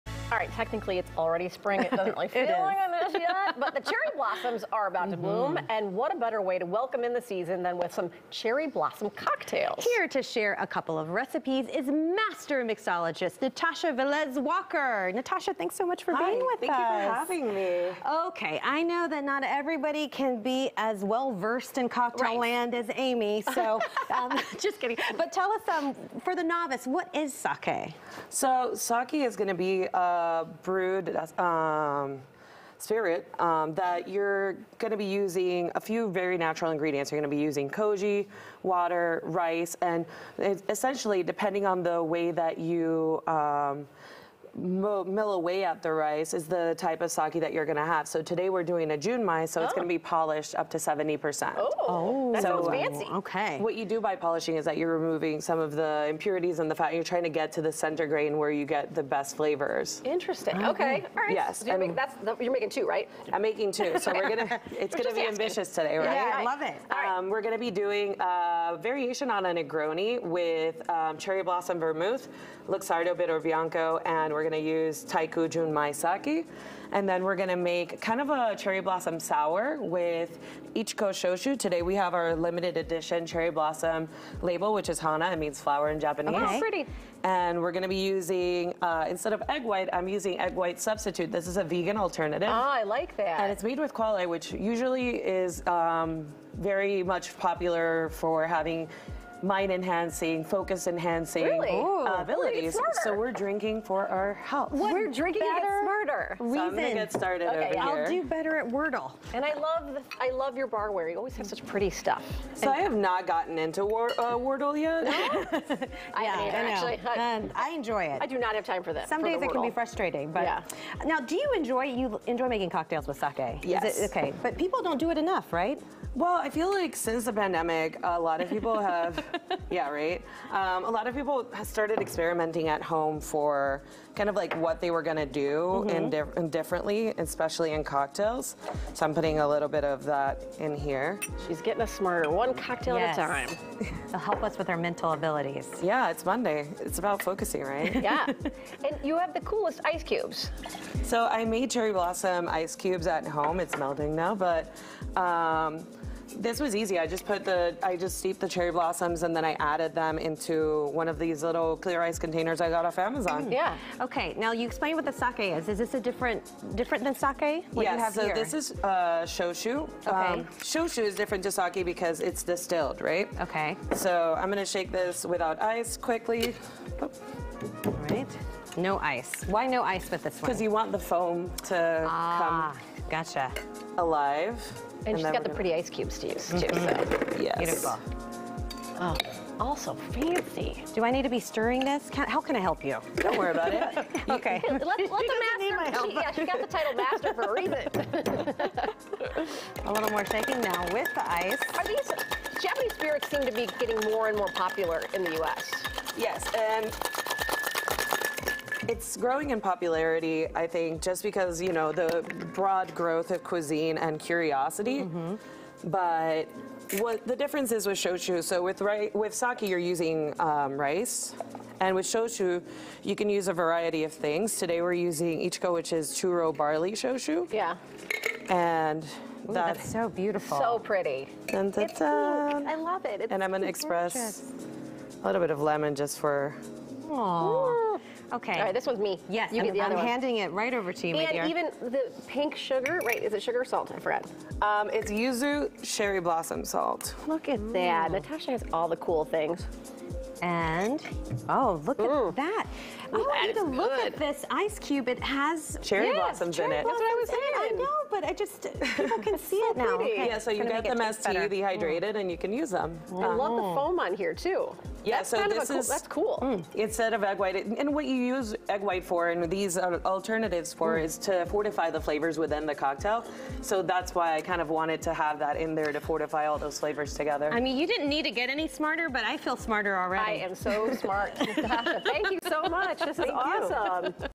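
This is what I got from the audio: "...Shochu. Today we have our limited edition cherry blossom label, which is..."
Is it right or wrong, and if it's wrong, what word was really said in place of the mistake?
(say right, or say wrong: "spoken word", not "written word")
right.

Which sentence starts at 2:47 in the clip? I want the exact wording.
What yeah, you have so here?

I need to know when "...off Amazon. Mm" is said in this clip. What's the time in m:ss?
2:42.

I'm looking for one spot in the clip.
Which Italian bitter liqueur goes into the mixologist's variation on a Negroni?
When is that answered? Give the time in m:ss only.
1:12.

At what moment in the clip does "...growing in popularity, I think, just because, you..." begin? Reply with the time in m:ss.
3:29.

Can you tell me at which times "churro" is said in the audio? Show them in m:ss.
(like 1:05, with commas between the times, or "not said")
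3:46.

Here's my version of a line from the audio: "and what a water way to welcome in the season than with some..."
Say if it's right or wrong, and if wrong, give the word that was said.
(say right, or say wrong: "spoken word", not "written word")
wrong: "better", not "water".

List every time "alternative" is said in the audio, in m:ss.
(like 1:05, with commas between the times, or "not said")
1:31, 4:30.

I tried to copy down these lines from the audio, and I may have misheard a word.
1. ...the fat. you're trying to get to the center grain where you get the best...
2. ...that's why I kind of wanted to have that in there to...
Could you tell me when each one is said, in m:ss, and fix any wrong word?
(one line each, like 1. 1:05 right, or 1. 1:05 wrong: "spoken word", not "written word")
1. 0:56 right
2. 4:33 right.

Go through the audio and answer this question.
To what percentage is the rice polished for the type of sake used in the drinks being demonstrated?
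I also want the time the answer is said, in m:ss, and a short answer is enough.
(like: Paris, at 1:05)
70%, at 0:50.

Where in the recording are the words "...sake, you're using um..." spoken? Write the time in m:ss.
3:39.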